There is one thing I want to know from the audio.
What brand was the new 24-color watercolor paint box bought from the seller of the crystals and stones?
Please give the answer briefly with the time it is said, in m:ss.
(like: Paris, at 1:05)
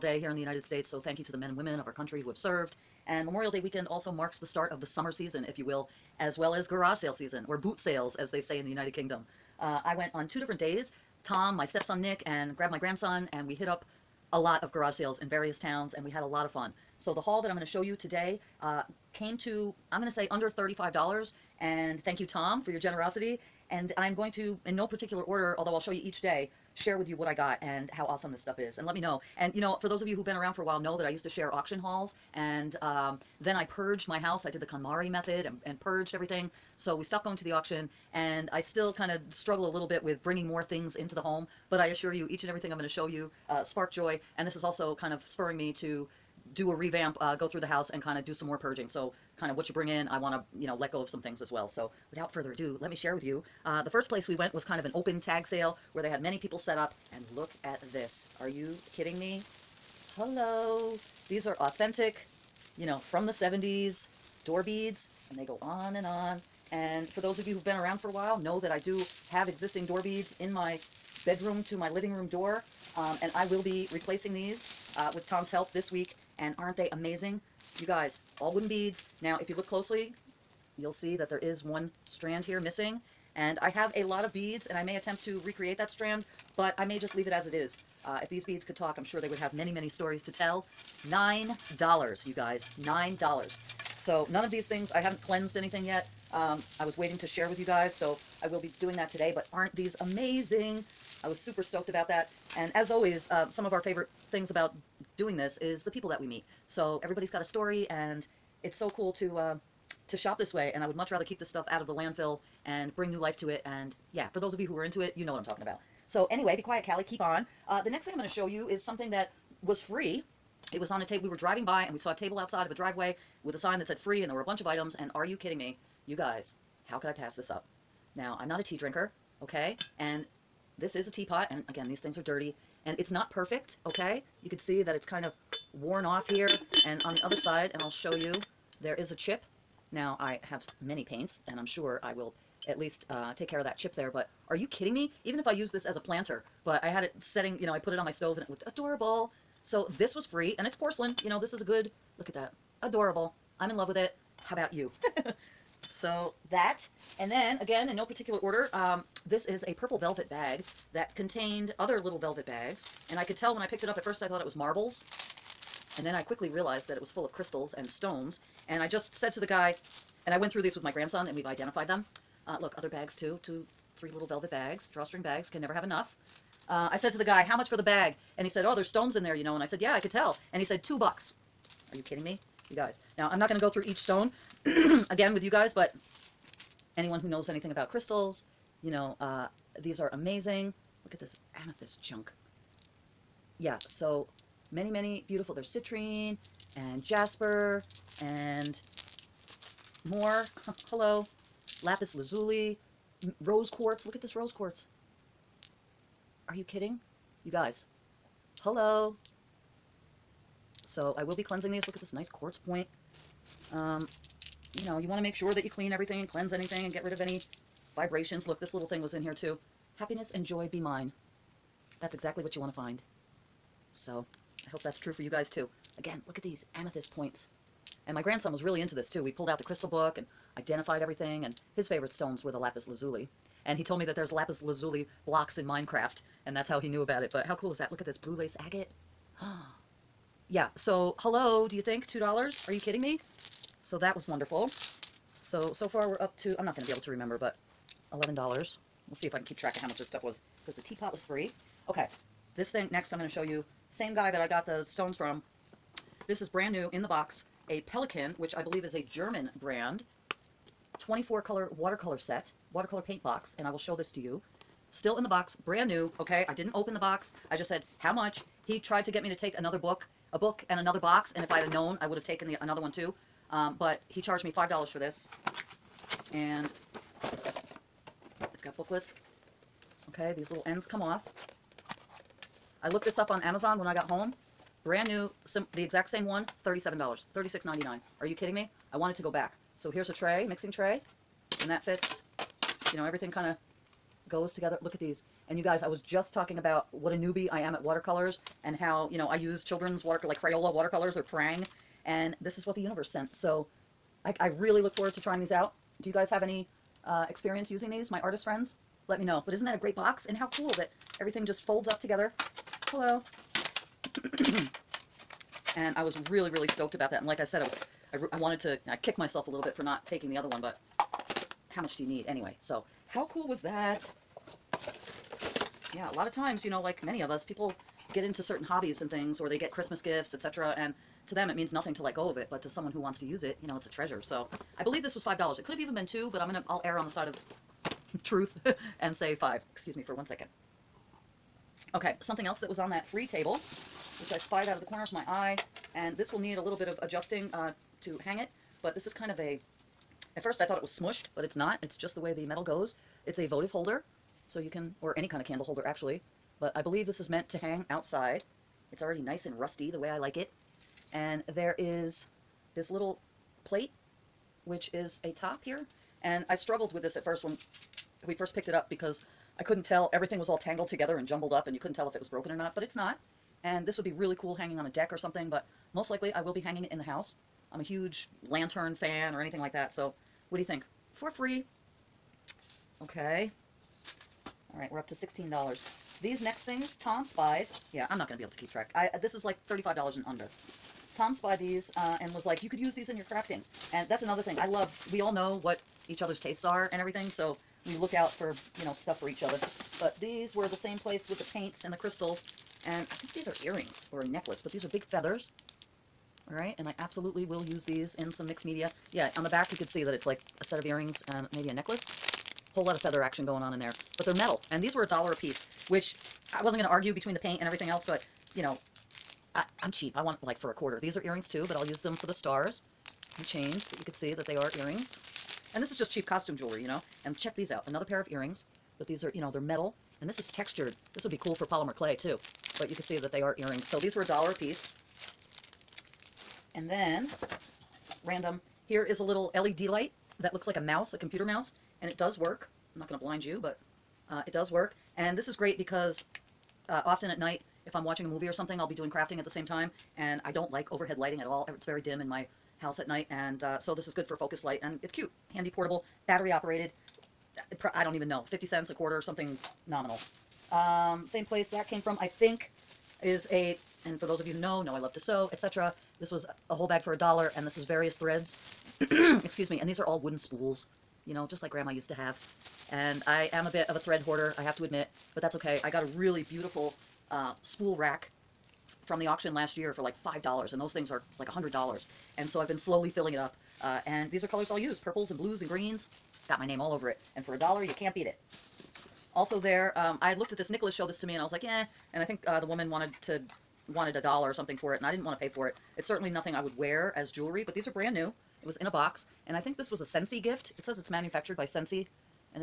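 Pelikan, at 4:17.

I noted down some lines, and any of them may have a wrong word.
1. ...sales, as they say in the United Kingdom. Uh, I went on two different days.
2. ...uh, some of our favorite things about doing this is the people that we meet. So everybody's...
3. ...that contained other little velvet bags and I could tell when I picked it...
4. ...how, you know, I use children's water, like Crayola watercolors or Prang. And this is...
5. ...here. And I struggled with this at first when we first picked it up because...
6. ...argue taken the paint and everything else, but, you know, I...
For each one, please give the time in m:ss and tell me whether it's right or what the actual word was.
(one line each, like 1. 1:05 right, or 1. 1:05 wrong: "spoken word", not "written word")
1. 0:07 right
2. 1:43 right
3. 2:40 right
4. 4:58 right
5. 6:05 right
6. 6:56 wrong: "between", not "taken".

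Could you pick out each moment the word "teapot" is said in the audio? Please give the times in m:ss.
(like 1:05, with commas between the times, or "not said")
2:11, 4:10.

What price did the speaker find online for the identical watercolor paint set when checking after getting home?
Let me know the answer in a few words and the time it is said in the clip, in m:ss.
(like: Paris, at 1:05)
$36.99, at 4:47.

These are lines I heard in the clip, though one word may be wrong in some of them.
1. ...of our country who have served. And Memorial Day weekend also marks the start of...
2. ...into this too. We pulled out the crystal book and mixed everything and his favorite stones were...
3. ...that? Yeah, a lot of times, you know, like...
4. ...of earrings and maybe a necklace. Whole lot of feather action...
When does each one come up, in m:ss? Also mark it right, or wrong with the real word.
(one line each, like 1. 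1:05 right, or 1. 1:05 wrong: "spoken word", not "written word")
1. 0:01 right
2. 3:48 wrong: "identified", not "mixed"
3. 5:23 right
4. 6:50 right.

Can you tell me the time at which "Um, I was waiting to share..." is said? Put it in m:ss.
1:36.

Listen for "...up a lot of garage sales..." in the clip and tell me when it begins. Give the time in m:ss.
0:13.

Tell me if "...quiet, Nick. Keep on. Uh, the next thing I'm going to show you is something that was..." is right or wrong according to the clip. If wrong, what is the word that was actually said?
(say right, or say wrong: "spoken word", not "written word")
wrong: "Cali", not "Nick".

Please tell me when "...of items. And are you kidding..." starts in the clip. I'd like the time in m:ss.
2:04.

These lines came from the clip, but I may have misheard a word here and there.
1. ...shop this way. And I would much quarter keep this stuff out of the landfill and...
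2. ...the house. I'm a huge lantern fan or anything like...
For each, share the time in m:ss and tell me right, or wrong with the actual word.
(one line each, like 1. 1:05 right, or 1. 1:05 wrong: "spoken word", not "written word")
1. 1:50 wrong: "rather", not "quarter"
2. 6:16 right.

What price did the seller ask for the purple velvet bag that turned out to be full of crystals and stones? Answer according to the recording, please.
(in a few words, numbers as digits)
$2.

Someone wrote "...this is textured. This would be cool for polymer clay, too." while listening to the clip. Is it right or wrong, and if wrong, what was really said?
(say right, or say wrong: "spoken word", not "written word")
right.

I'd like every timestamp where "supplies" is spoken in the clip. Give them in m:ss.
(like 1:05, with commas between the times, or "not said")
not said.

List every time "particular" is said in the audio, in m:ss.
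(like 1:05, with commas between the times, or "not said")
0:24, 2:38.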